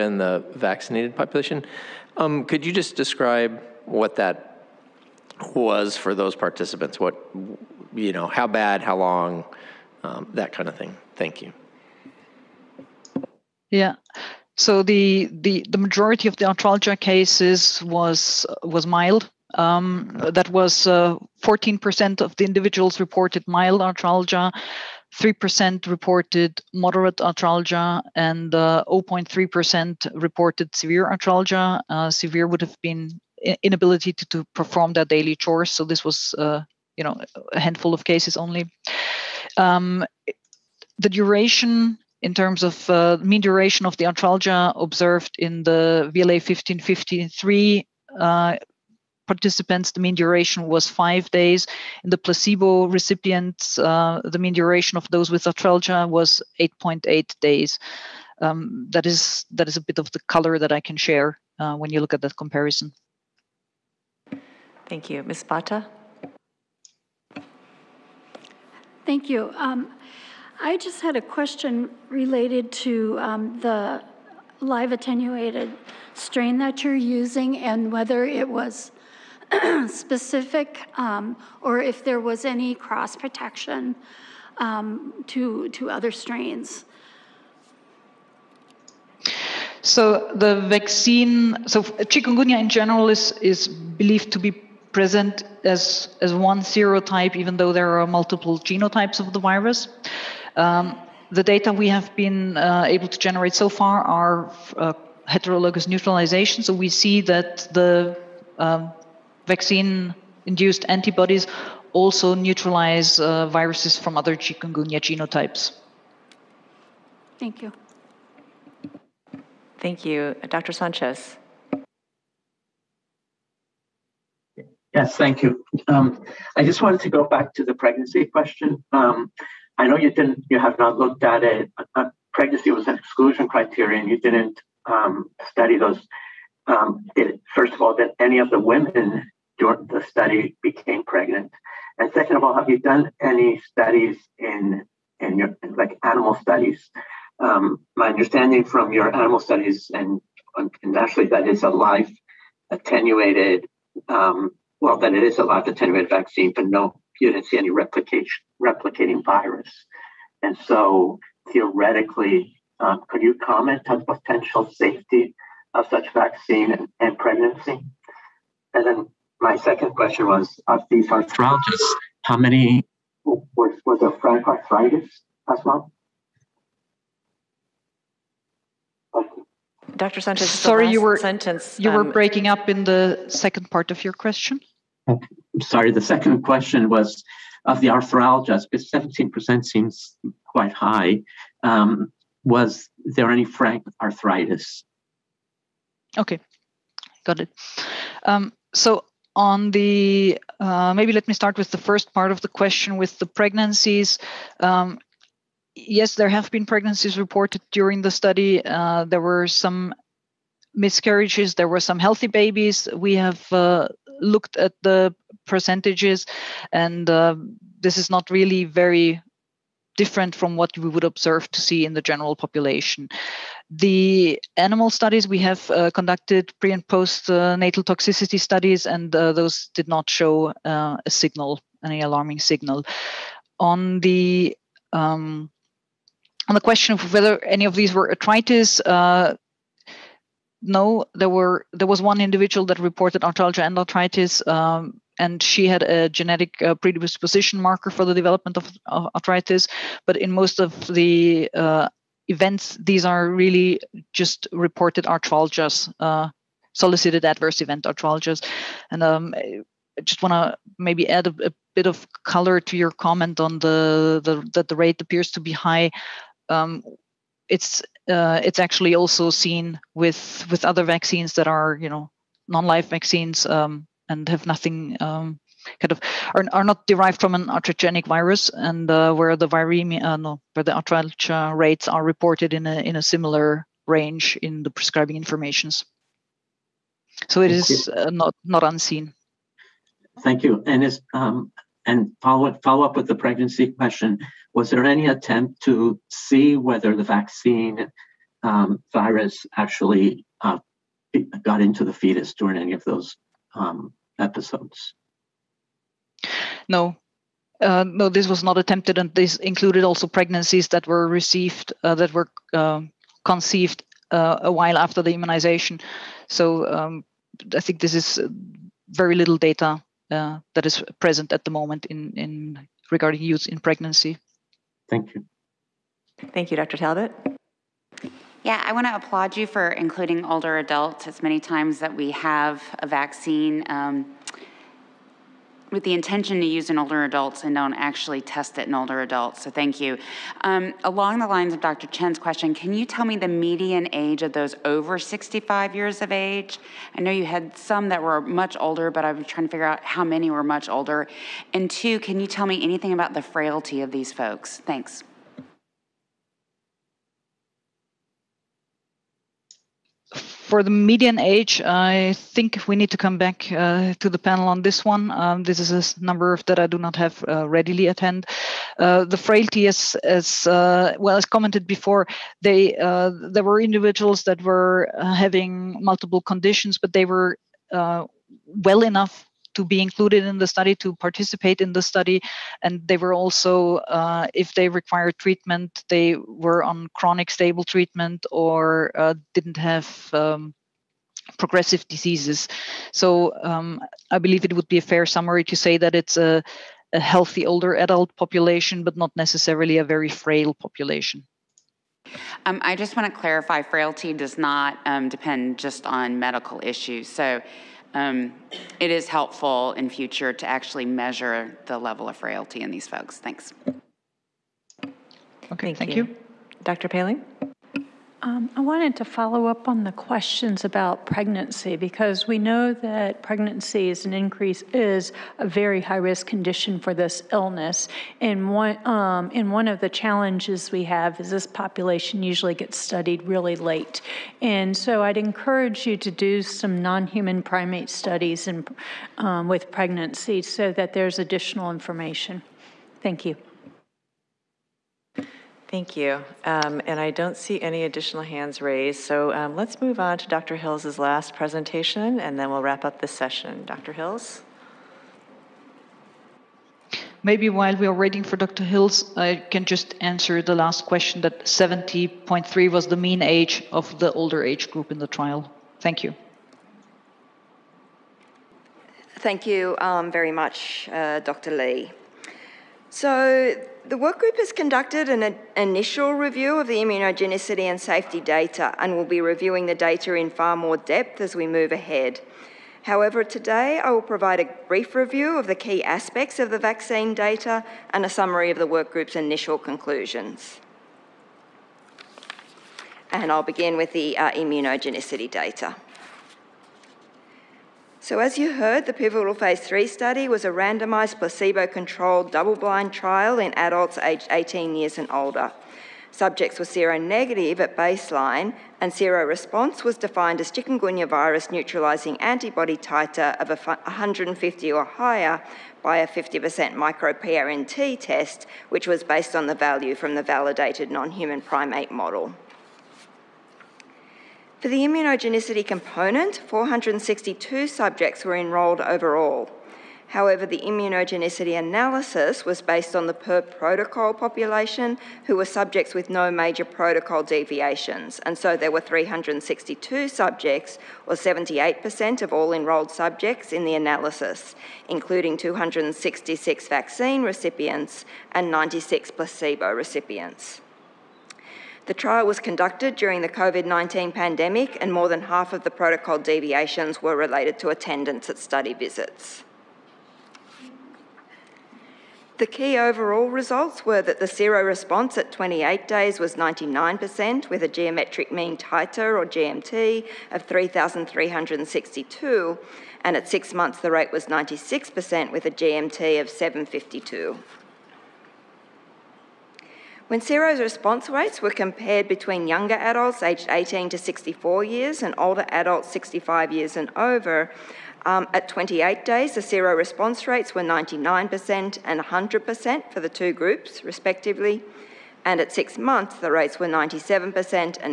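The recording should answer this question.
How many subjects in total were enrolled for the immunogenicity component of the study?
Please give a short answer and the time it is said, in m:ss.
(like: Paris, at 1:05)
462, at 8:46.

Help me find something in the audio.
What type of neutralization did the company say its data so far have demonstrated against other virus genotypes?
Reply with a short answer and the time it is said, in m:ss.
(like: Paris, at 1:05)
Heterologous neutralization, at 1:45.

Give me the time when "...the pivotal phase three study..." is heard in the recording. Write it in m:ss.
8:18.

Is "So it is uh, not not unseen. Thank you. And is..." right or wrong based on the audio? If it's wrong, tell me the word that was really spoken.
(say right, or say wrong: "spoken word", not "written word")
right.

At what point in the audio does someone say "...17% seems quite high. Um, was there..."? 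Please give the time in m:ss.
3:08.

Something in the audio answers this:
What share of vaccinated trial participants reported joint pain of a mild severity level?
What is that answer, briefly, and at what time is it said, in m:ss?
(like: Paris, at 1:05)
14%, at 0:20.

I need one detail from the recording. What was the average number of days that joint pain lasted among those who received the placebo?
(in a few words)
8.8 days.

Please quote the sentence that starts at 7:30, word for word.
Hills's last presentation, and then we'll wrap up this session.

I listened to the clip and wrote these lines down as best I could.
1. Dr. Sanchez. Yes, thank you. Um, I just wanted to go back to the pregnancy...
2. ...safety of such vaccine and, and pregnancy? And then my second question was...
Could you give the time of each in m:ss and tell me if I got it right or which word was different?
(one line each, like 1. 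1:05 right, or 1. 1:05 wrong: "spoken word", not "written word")
1. 2:00 right
2. 2:44 right.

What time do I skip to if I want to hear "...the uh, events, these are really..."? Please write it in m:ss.
4:10.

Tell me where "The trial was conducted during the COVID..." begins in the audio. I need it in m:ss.
9:11.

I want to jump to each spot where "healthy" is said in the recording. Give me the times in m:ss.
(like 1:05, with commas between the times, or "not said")
3:31, 6:36.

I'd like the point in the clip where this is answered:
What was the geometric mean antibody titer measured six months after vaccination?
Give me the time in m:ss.
9:36.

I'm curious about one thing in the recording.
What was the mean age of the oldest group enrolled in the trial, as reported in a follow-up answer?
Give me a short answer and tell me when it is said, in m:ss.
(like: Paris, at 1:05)
70.3, at 7:41.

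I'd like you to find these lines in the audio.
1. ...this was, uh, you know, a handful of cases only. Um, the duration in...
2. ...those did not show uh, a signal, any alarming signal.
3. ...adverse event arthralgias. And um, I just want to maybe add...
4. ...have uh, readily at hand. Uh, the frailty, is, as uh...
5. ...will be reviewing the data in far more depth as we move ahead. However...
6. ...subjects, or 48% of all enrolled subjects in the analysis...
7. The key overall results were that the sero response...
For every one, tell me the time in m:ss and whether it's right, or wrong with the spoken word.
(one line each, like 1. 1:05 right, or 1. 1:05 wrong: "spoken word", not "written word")
1. 0:35 right
2. 3:49 right
3. 4:17 right
4. 6:06 right
5. 7:58 right
6. 9:00 wrong: "78", not "48"
7. 9:22 right.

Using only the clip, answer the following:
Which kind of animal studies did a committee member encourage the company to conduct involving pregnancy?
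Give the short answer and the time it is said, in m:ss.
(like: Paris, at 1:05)
Non-human primate studies, at 7:16.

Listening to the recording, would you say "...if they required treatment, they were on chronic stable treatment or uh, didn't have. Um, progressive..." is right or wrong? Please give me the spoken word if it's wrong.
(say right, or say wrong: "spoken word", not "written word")
right.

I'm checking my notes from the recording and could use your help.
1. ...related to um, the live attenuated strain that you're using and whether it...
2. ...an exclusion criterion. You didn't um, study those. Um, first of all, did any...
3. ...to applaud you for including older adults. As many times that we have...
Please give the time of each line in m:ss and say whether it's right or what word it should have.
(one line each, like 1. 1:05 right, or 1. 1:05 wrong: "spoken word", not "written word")
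1. 1:12 right
2. 2:12 right
3. 5:28 right.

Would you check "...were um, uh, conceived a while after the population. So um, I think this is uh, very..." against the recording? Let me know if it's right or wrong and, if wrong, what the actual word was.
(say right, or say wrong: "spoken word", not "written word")
wrong: "immunization", not "population".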